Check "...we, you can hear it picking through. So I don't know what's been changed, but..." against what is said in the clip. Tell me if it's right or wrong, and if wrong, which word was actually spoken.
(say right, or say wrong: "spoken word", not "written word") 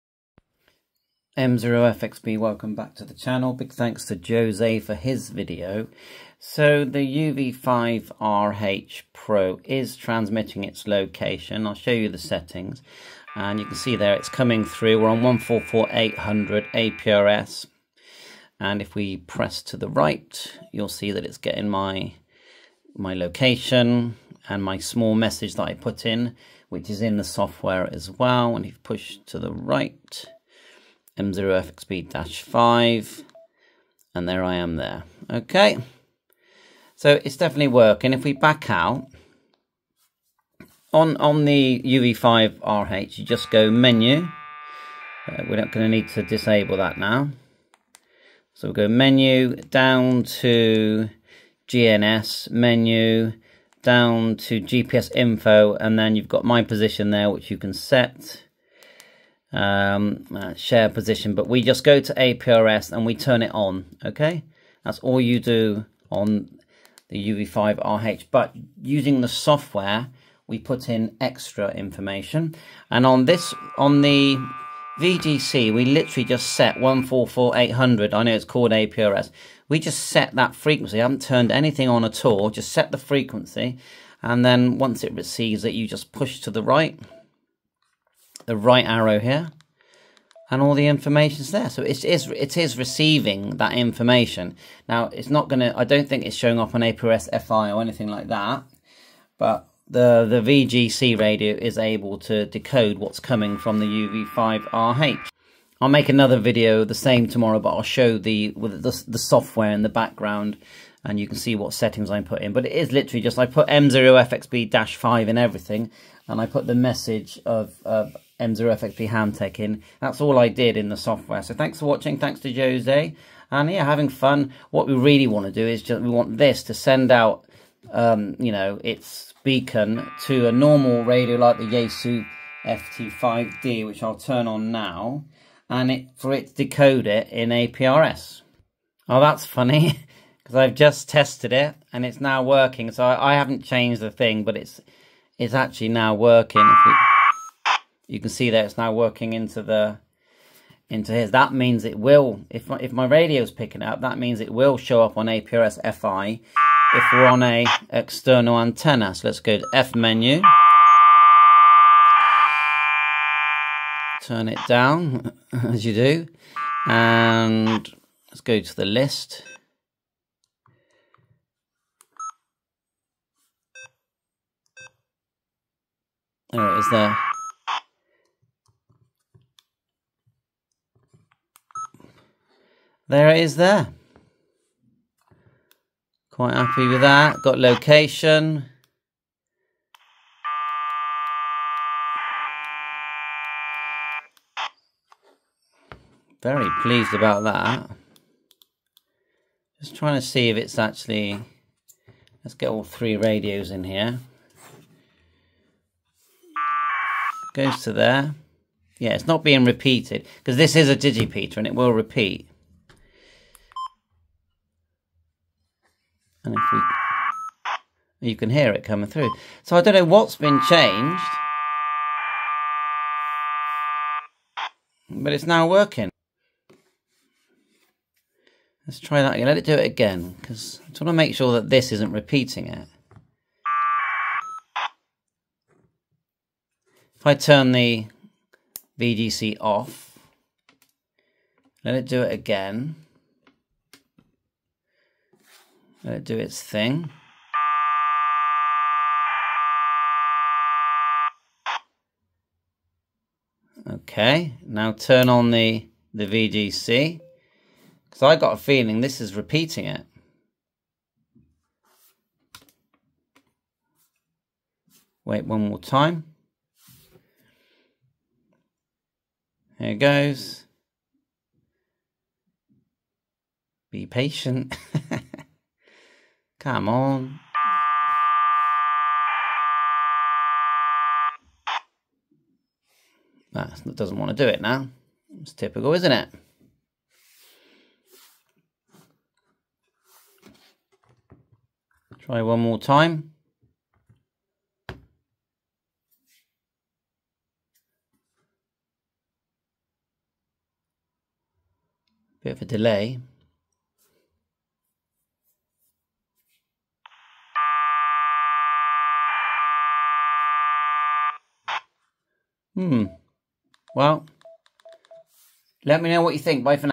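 wrong: "coming", not "picking".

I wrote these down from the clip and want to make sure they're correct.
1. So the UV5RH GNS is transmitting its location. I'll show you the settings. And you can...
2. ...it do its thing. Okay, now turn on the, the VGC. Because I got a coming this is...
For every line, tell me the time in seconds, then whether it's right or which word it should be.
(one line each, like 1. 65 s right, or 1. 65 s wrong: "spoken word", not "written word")
1. 6 s wrong: "Pro", not "GNS"
2. 246 s wrong: "feeling", not "coming".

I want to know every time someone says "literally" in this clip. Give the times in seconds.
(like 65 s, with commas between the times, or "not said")
75 s, 112 s.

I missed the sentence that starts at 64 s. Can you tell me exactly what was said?
That's all you do on the UV5RH, but using the software, we put in extra information.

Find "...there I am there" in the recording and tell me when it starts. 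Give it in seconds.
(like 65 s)
34 s.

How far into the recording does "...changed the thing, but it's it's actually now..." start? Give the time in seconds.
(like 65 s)
143 s.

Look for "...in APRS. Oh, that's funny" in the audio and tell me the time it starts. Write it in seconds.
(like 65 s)
137 s.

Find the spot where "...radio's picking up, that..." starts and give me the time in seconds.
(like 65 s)
153 s.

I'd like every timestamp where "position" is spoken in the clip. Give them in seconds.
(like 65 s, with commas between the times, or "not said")
56 s, 60 s.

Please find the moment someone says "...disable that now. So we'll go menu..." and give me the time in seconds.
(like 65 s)
46 s.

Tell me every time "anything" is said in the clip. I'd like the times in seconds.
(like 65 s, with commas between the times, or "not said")
81 s, 97 s.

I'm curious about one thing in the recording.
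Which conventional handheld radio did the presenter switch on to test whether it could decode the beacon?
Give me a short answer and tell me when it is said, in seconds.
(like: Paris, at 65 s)
Yaesu FT5D, at 131 s.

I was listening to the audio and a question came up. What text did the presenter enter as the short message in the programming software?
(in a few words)
M0FXB Ham Tech.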